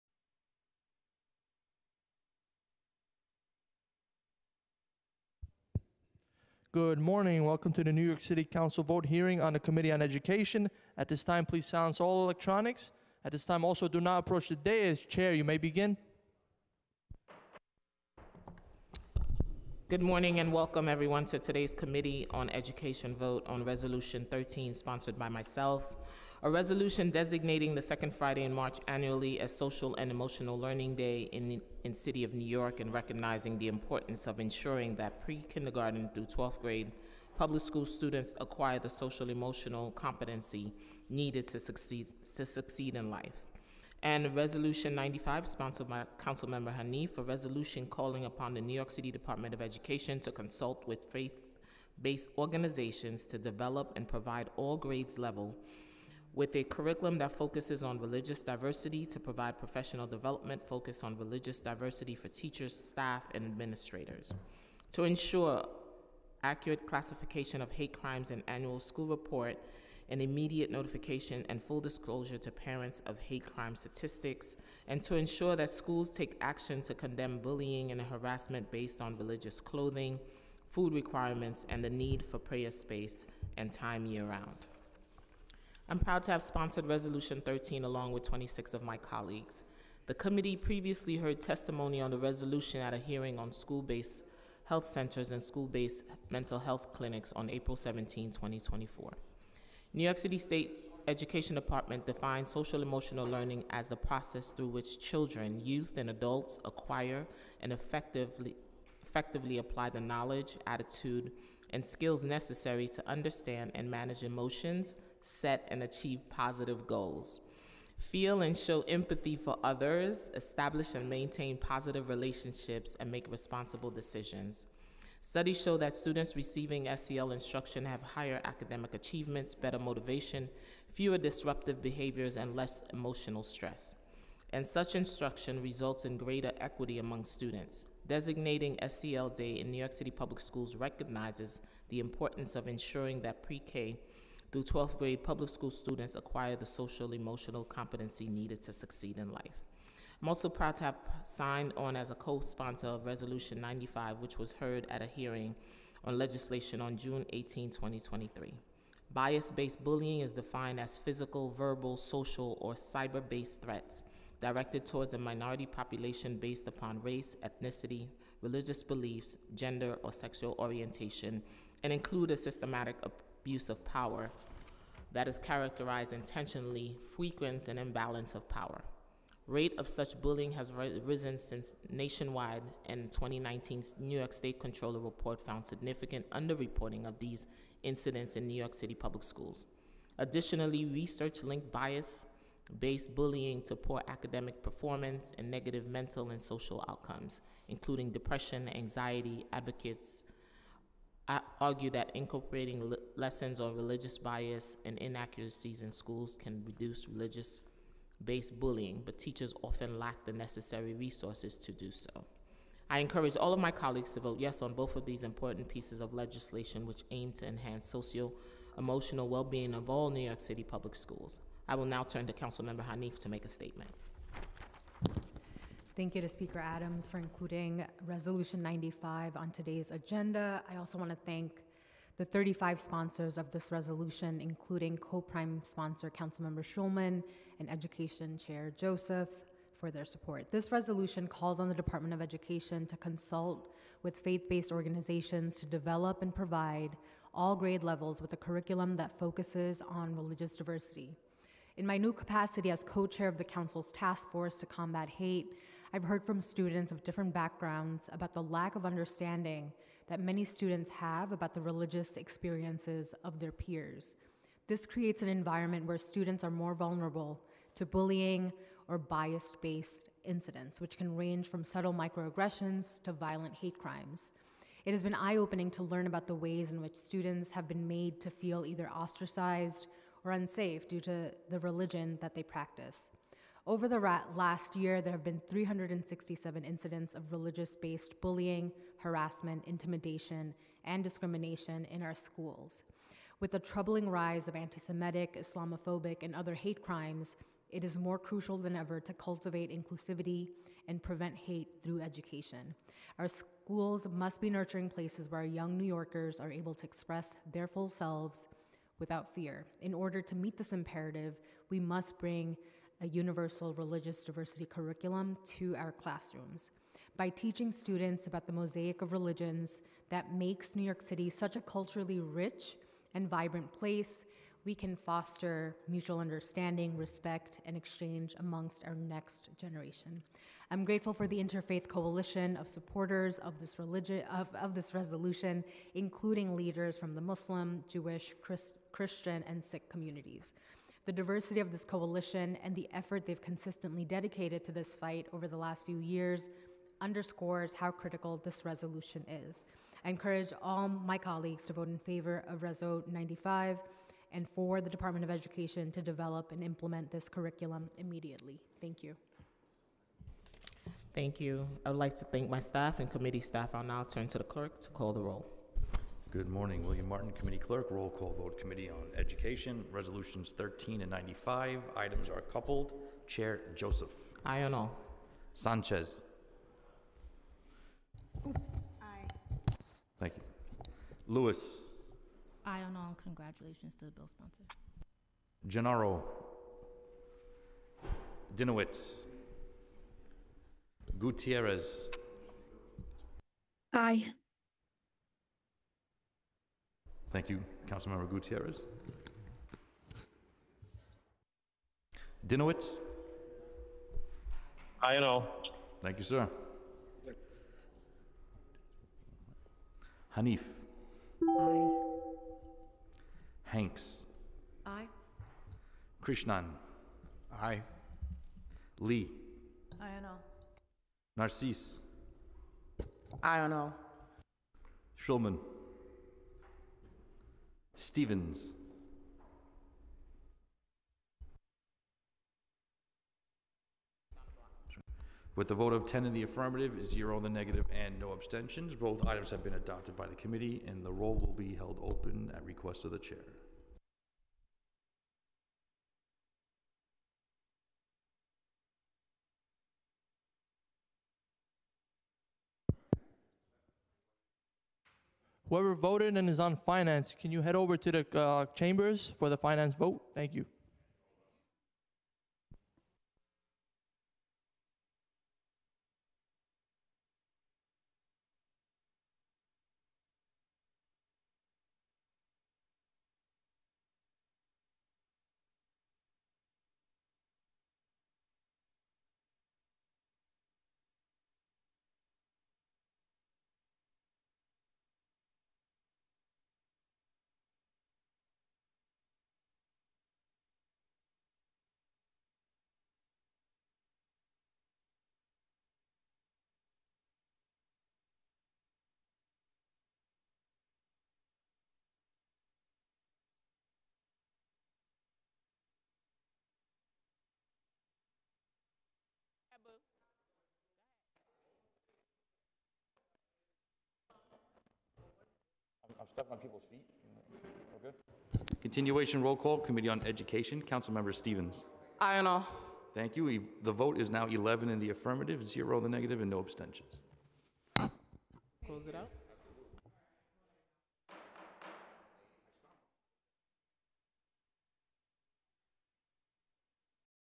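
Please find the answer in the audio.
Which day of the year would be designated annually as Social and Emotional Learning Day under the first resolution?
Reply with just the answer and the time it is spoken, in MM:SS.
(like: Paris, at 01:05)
Second Friday in March, at 00:27.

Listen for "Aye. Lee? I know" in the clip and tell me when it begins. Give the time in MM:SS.
06:57.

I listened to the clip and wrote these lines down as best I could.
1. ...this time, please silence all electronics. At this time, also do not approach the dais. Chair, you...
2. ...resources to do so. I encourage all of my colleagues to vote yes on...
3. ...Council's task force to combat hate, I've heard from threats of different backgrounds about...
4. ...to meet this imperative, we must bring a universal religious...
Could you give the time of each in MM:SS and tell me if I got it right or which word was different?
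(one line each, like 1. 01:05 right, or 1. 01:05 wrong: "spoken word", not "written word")
1. 00:11 right
2. 03:30 right
3. 04:13 wrong: "students", not "threats"
4. 05:10 right.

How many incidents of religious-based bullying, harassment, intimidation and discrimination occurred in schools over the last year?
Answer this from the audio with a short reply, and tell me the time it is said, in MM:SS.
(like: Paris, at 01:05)
367, at 04:45.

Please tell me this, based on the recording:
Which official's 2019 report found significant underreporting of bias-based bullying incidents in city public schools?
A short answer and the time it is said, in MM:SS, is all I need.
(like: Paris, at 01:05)
New York State Comptroller, at 03:03.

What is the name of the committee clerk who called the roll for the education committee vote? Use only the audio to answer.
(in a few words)
William Martin.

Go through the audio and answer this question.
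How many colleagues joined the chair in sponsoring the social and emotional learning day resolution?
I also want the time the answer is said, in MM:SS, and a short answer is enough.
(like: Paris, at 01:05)
26, at 01:28.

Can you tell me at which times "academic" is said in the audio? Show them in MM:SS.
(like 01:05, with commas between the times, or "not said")
02:08, 03:14.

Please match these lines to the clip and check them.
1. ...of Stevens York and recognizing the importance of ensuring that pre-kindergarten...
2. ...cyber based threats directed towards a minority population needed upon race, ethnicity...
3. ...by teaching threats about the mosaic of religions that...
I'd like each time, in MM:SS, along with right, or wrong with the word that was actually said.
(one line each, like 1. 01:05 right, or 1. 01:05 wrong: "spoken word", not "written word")
1. 00:32 wrong: "New", not "Stevens"
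2. 02:42 wrong: "based", not "needed"
3. 05:17 wrong: "students", not "threats".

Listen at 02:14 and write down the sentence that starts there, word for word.
And such instruction results in greater equity among students.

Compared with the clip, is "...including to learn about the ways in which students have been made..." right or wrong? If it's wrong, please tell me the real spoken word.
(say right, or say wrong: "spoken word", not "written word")
wrong: "opening", not "including".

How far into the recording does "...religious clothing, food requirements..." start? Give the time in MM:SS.
01:19.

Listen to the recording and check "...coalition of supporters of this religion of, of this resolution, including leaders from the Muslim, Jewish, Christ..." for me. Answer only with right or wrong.
right.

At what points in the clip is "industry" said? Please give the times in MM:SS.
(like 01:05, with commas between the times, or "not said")
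not said.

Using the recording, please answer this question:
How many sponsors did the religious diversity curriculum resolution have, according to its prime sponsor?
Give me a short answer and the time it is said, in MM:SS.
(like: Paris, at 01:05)
35, at 03:52.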